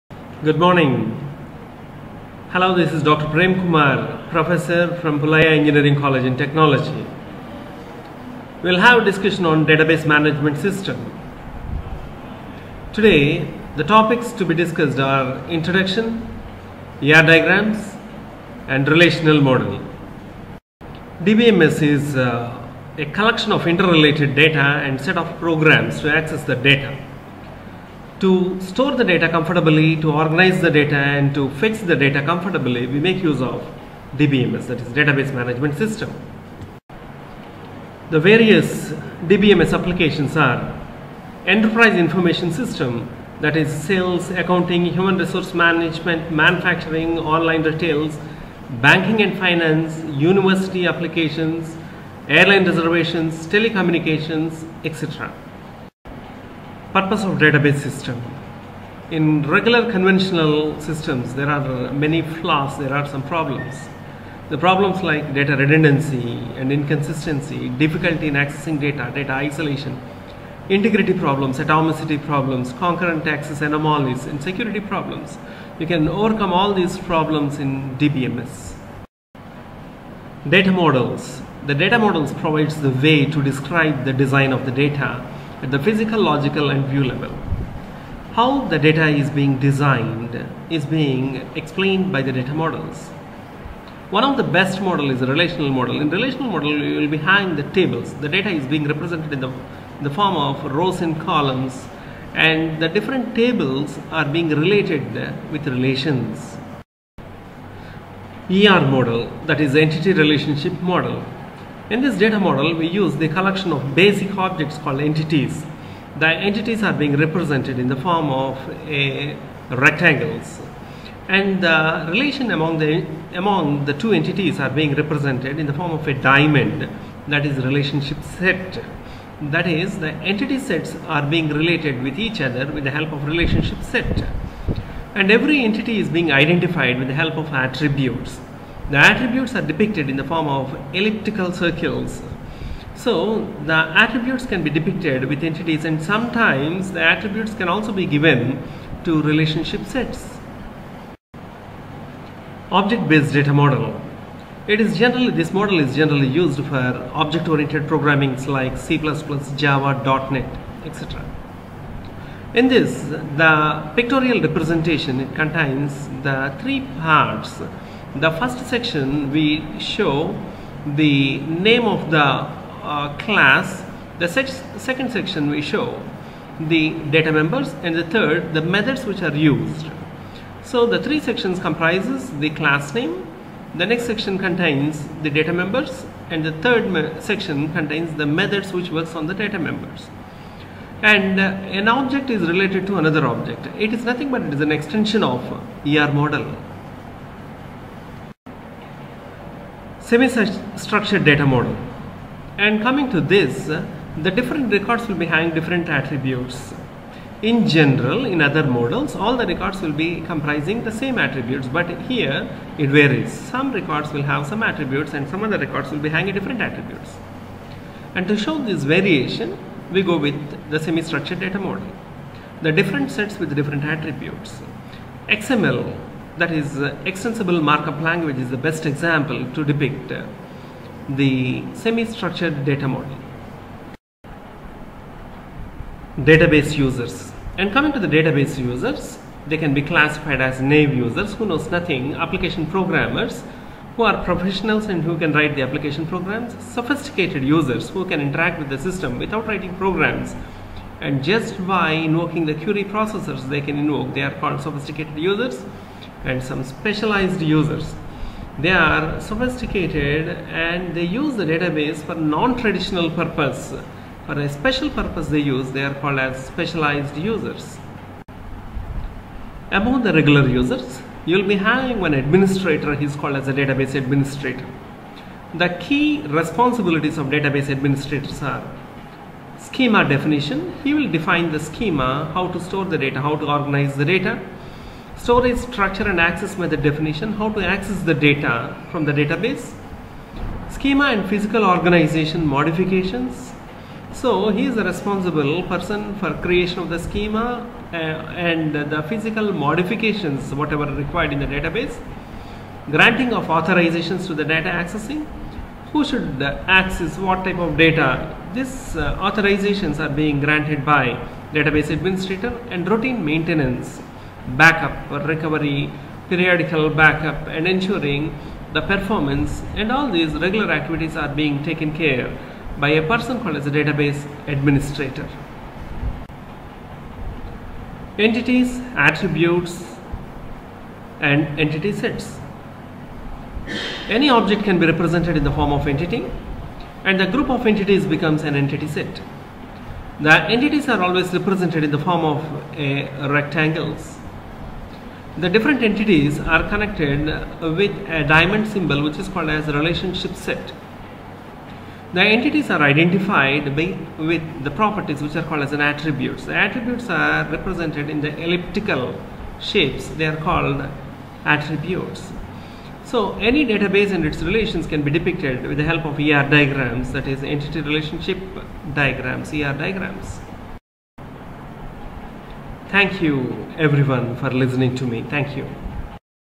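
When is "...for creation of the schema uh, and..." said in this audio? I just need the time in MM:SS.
04:56.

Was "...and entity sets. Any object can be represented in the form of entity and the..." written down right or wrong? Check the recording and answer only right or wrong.
right.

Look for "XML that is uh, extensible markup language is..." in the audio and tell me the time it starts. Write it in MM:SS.
03:45.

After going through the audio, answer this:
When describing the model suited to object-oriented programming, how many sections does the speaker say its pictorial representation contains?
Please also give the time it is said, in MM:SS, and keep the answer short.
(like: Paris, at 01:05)
3, at 02:46.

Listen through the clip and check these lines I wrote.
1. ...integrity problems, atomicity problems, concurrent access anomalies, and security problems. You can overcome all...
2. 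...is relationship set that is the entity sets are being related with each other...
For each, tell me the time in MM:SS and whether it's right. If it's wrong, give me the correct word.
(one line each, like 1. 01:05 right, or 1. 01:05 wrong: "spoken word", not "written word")
1. 01:10 right
2. 02:07 right.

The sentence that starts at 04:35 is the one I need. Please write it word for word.
The key responsibilities of database administrators are schema definition.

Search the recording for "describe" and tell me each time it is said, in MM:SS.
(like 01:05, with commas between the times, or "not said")
01:23.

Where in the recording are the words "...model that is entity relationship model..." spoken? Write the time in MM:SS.
01:48.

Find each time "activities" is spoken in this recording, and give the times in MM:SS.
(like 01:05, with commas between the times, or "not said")
05:20.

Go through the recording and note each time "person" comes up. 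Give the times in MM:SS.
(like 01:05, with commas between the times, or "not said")
04:55, 05:23.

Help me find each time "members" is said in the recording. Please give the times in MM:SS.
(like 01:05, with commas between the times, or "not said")
02:57, 03:05, 03:09.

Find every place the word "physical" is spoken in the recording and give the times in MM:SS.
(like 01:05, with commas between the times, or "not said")
01:25, 04:51, 04:59.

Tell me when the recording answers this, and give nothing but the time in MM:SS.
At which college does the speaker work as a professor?
00:05.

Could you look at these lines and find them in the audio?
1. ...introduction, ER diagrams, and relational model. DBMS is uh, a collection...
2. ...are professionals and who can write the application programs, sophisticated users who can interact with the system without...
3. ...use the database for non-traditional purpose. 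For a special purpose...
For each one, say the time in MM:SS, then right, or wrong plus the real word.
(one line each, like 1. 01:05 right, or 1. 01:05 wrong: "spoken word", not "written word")
1. 00:15 right
2. 04:04 right
3. 04:21 right.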